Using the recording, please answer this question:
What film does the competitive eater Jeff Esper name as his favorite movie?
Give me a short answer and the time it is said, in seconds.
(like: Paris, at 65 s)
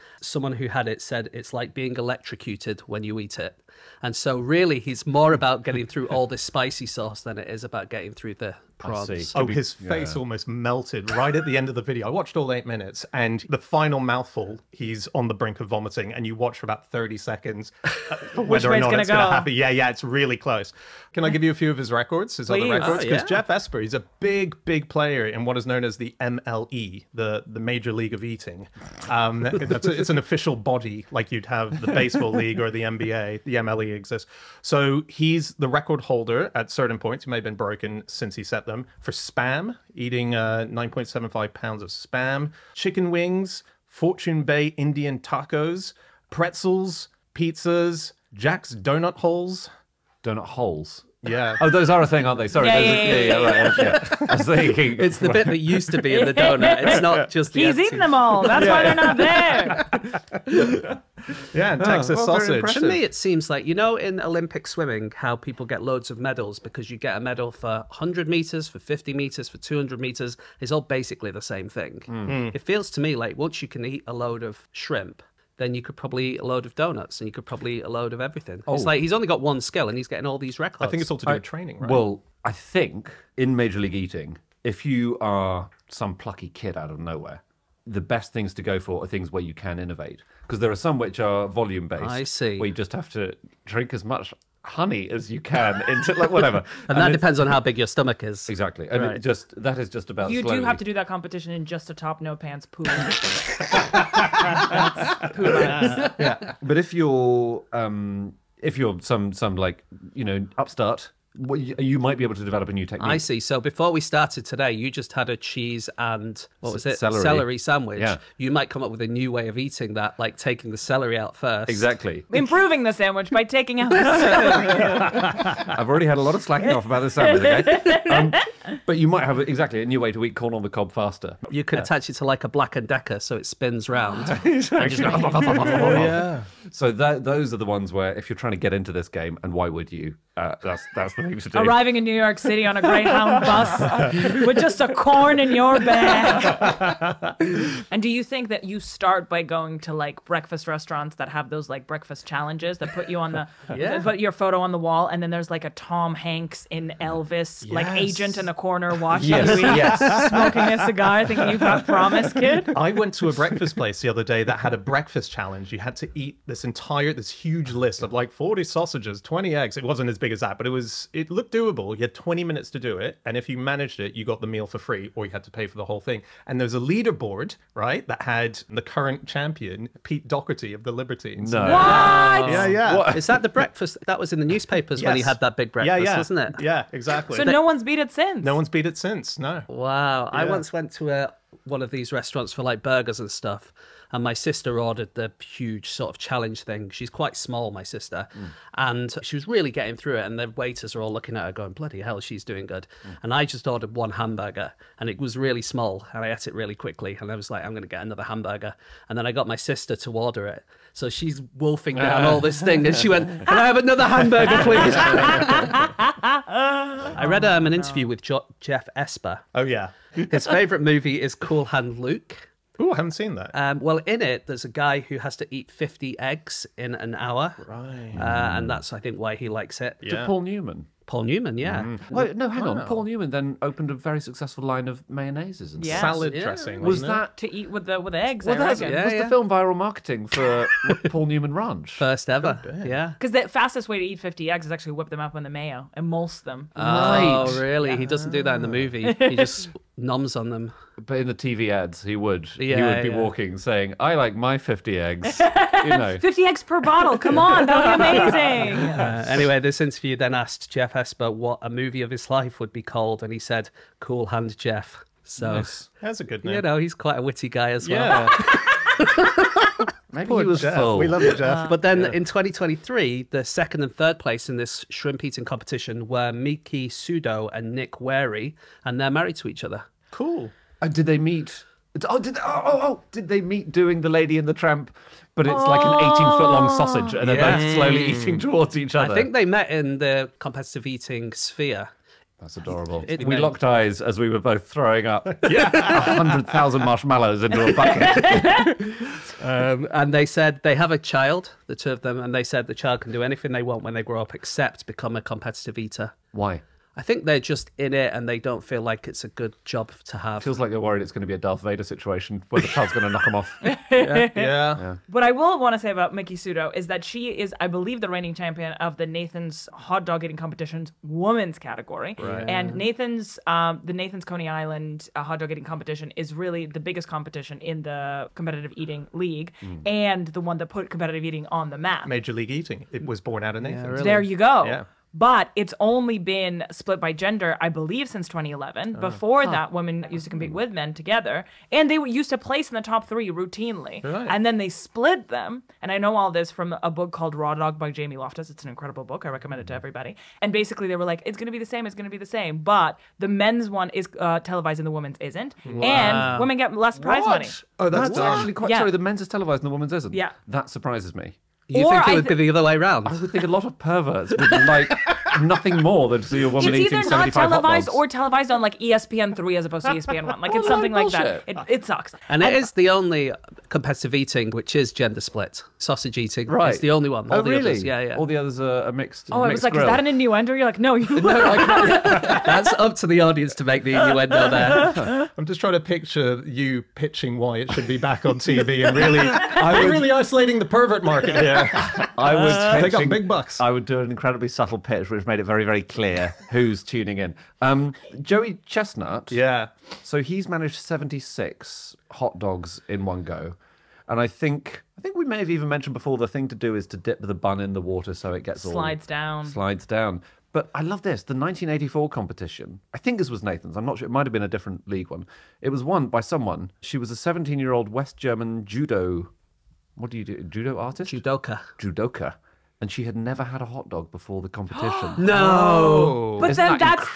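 Cool Hand Luke, at 221 s.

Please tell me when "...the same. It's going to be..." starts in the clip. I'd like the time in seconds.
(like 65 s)
351 s.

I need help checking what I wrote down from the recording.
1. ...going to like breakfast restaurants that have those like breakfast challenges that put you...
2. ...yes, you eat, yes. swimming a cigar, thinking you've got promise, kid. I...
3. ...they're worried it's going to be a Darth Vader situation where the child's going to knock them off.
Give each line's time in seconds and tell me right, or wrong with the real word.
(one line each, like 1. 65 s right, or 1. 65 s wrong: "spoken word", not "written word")
1. 149 s right
2. 159 s wrong: "smoking", not "swimming"
3. 310 s right.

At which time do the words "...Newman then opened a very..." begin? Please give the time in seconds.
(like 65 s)
233 s.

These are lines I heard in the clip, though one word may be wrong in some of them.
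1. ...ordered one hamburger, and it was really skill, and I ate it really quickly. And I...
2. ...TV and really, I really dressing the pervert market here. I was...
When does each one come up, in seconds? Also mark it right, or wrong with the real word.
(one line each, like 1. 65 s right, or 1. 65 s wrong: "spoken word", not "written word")
1. 203 s wrong: "small", not "skill"
2. 388 s wrong: "isolating", not "dressing".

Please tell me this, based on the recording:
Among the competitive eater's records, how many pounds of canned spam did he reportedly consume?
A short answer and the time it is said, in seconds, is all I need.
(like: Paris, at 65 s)
9.75, at 40 s.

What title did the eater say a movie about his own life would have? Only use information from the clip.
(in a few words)
Cool Hand Jeff.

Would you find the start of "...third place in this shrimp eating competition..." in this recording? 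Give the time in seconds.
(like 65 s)
273 s.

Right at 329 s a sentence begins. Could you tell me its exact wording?
and the one that put competitive eating on the map.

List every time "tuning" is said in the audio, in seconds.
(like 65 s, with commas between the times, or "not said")
396 s.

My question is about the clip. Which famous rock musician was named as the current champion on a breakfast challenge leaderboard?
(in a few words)
Pete Doherty.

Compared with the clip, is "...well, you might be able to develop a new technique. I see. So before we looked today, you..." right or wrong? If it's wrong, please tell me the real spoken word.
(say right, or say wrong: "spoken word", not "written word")
wrong: "started", not "looked".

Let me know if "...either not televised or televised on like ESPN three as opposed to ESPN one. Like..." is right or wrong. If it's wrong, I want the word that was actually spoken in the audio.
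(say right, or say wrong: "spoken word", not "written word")
right.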